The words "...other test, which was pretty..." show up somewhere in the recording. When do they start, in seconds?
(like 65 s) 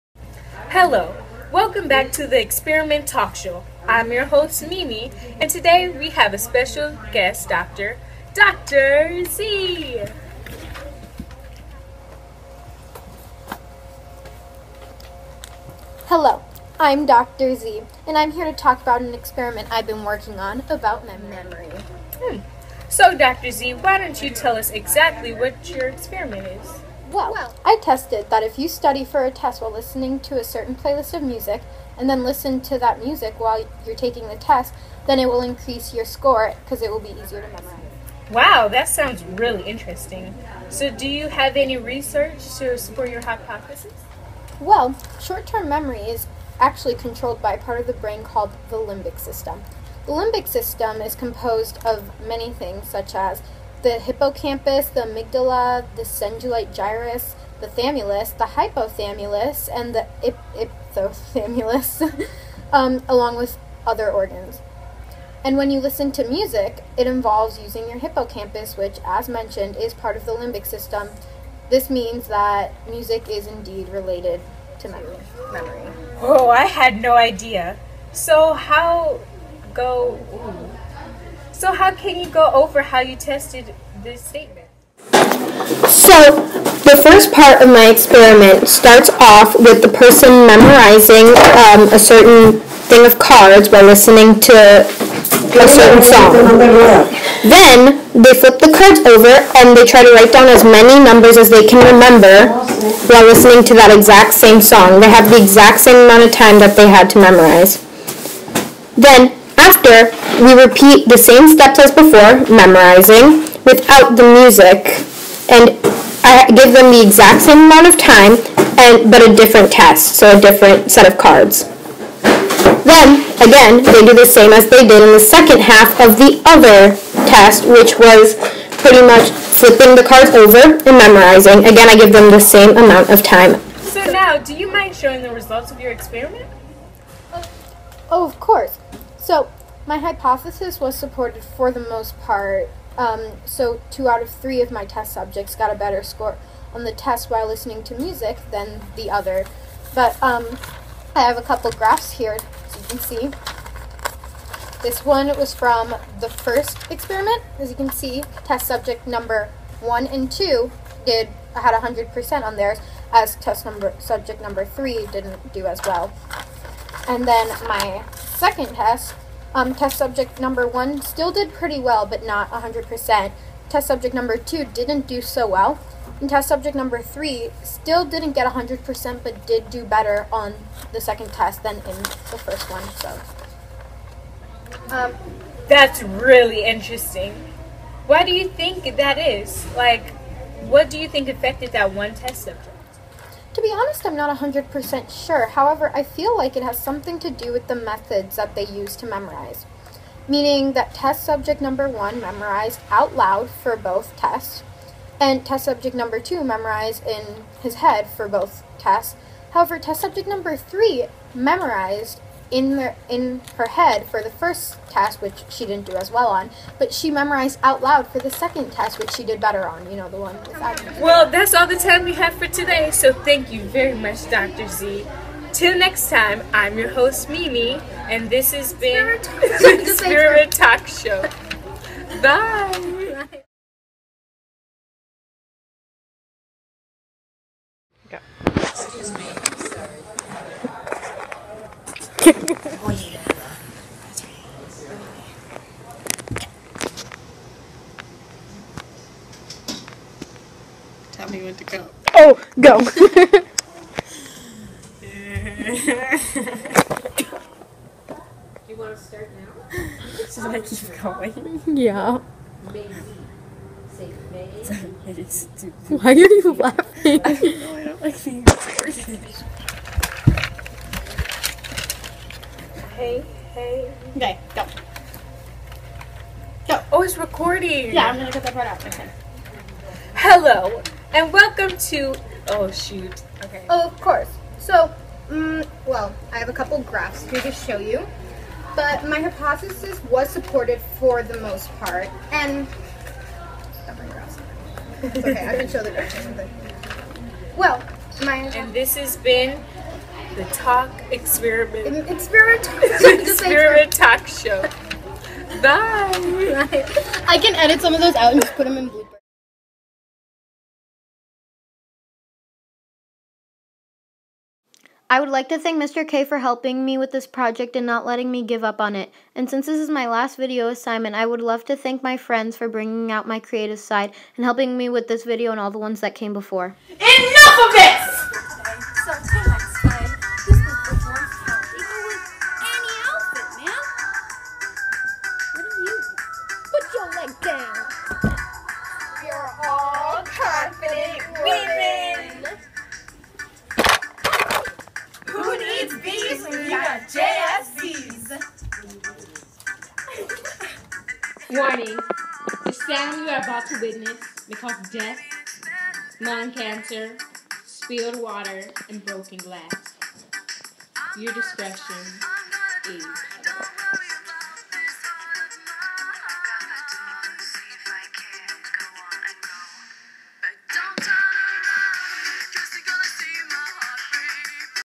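126 s.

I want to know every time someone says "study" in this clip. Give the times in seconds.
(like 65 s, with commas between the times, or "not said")
28 s.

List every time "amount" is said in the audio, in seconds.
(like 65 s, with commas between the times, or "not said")
106 s, 117 s, 132 s.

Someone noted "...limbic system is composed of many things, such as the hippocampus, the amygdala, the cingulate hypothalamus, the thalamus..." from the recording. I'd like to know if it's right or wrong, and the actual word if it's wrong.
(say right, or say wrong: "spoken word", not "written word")
wrong: "gyrus", not "hypothalamus".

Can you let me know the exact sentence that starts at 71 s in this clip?
This means that music is indeed related to memory.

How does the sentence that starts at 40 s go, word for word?
So, do you have any research to support your hypothesis?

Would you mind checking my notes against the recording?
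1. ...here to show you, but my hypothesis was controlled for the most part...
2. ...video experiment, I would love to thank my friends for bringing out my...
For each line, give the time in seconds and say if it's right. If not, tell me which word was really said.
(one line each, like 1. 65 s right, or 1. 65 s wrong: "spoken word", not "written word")
1. 287 s wrong: "supported", not "controlled"
2. 320 s wrong: "assignment", not "experiment".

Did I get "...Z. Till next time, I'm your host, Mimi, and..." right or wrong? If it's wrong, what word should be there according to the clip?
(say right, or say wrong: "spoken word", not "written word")
right.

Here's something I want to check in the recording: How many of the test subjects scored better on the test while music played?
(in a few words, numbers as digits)
2.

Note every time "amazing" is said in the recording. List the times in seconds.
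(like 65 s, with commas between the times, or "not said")
not said.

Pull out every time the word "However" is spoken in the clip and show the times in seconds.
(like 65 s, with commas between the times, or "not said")
195 s, 209 s.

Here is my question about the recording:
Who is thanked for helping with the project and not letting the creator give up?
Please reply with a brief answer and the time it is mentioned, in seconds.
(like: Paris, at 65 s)
Mr. K, at 315 s.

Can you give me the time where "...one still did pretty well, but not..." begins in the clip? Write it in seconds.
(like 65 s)
170 s.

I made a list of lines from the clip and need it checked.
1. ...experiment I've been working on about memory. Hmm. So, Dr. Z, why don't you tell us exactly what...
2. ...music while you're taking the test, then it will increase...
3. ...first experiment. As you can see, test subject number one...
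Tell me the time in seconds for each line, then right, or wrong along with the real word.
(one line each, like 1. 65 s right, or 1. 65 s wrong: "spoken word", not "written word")
1. 19 s right
2. 33 s right
3. 156 s right.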